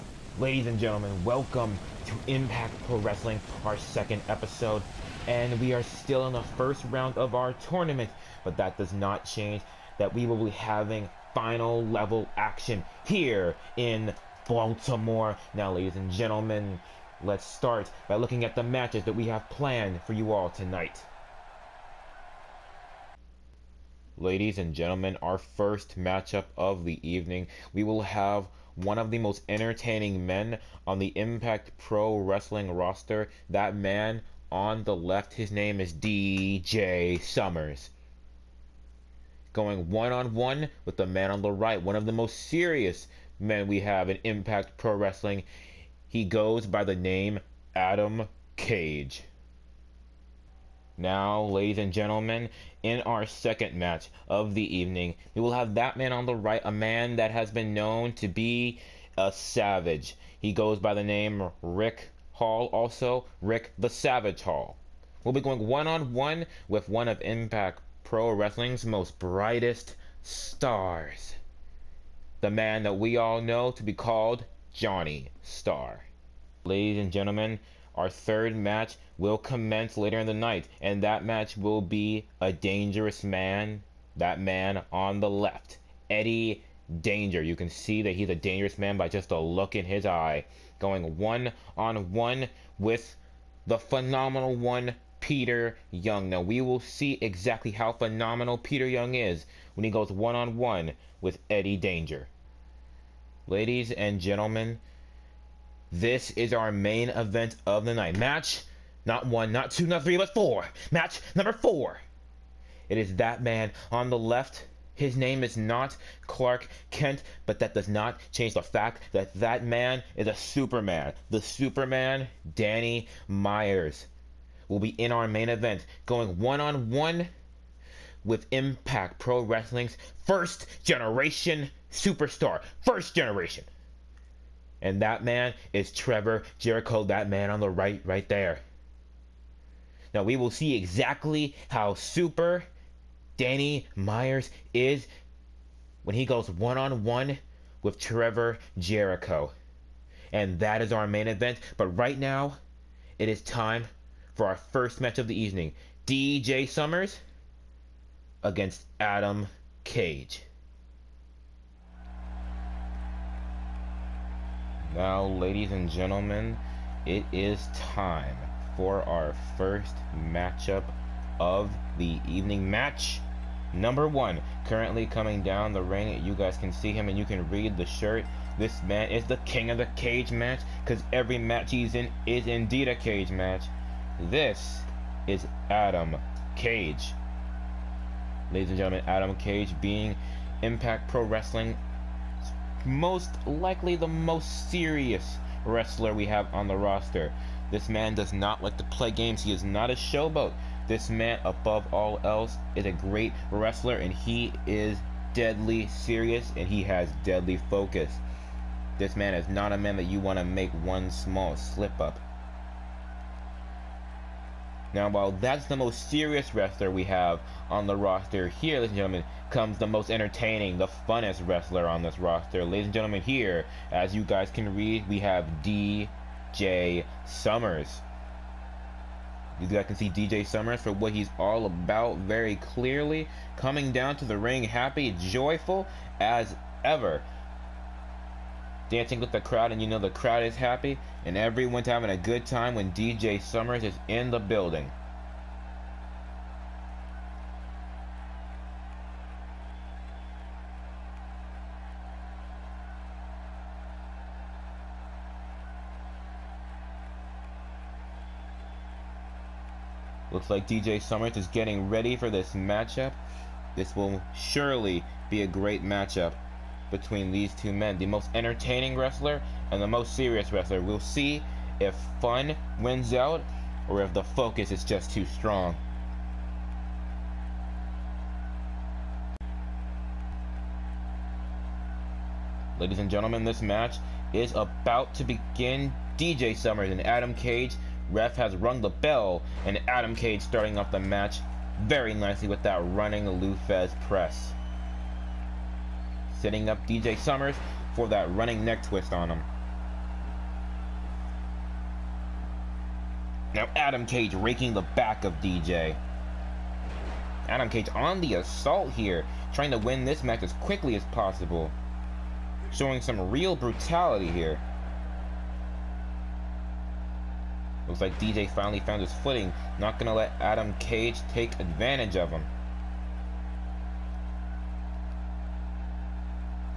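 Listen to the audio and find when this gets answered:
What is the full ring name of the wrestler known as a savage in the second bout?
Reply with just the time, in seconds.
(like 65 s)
63 s.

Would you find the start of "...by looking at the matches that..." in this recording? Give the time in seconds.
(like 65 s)
18 s.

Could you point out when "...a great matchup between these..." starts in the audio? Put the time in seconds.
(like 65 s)
265 s.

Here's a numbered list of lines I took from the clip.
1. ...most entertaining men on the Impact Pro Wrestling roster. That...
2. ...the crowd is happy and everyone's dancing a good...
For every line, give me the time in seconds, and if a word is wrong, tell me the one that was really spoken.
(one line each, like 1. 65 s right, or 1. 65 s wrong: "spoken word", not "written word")
1. 29 s right
2. 239 s wrong: "having", not "dancing".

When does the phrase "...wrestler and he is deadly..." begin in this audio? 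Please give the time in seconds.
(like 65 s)
203 s.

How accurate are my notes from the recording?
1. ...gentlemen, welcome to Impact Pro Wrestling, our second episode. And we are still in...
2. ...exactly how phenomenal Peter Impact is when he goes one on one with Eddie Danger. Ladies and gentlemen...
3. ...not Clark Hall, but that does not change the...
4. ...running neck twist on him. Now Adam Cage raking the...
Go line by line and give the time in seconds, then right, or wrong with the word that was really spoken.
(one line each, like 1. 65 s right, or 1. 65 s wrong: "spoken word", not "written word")
1. 0 s right
2. 97 s wrong: "Young", not "Impact"
3. 115 s wrong: "Kent", not "Hall"
4. 298 s right.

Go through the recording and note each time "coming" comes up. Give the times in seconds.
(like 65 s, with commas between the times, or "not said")
175 s, 233 s.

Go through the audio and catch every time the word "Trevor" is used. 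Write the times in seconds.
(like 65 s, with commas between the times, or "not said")
135 s, 147 s.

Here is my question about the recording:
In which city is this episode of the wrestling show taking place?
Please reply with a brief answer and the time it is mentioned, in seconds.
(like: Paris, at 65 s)
Baltimore, at 14 s.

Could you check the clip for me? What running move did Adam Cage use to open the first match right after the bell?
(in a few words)
Lou Thesz press.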